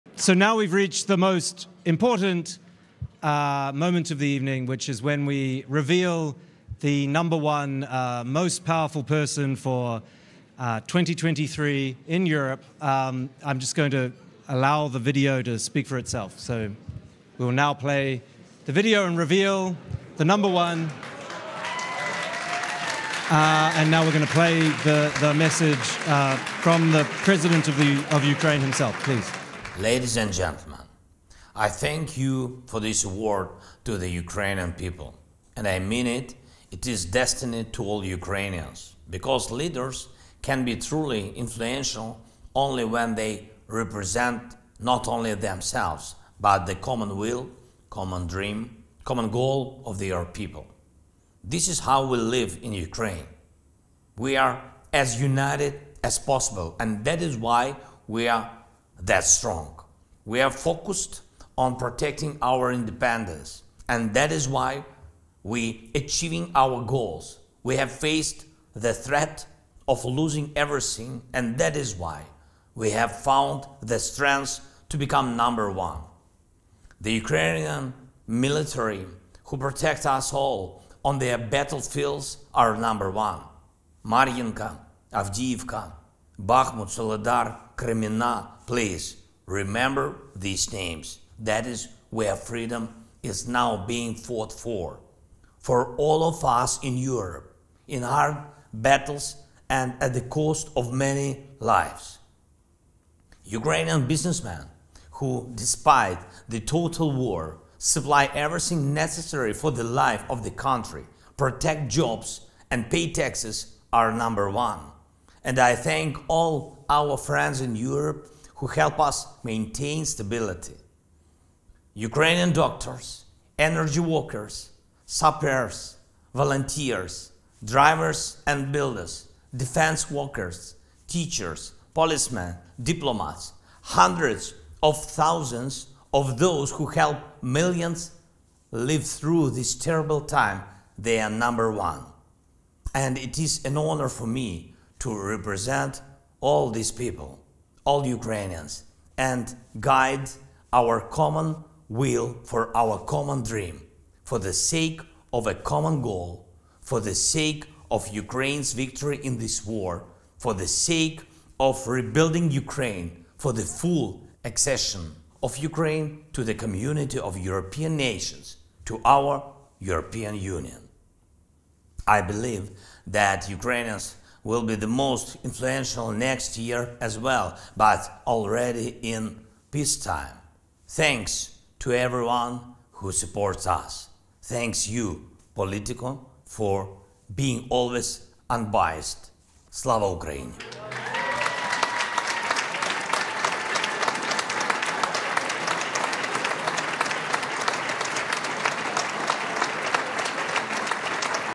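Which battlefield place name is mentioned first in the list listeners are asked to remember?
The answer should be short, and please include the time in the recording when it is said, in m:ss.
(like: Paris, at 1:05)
Mariinka, at 1:24.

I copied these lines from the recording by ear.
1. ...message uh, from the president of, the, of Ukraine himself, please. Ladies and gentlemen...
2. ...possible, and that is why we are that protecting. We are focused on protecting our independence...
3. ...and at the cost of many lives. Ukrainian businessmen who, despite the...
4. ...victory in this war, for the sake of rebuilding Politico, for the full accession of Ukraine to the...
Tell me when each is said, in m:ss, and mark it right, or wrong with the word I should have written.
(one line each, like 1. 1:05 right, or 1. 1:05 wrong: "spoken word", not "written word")
1. 0:25 right
2. 0:56 wrong: "strong", not "protecting"
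3. 1:39 right
4. 2:38 wrong: "Ukraine", not "Politico".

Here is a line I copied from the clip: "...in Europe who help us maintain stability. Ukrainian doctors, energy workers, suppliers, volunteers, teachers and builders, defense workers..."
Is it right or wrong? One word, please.
wrong.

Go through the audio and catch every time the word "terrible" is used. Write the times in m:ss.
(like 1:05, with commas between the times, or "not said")
2:19.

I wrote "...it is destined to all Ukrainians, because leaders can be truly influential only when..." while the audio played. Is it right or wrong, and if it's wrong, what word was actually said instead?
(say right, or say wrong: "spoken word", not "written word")
right.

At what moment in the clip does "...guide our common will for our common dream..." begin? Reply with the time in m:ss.
2:29.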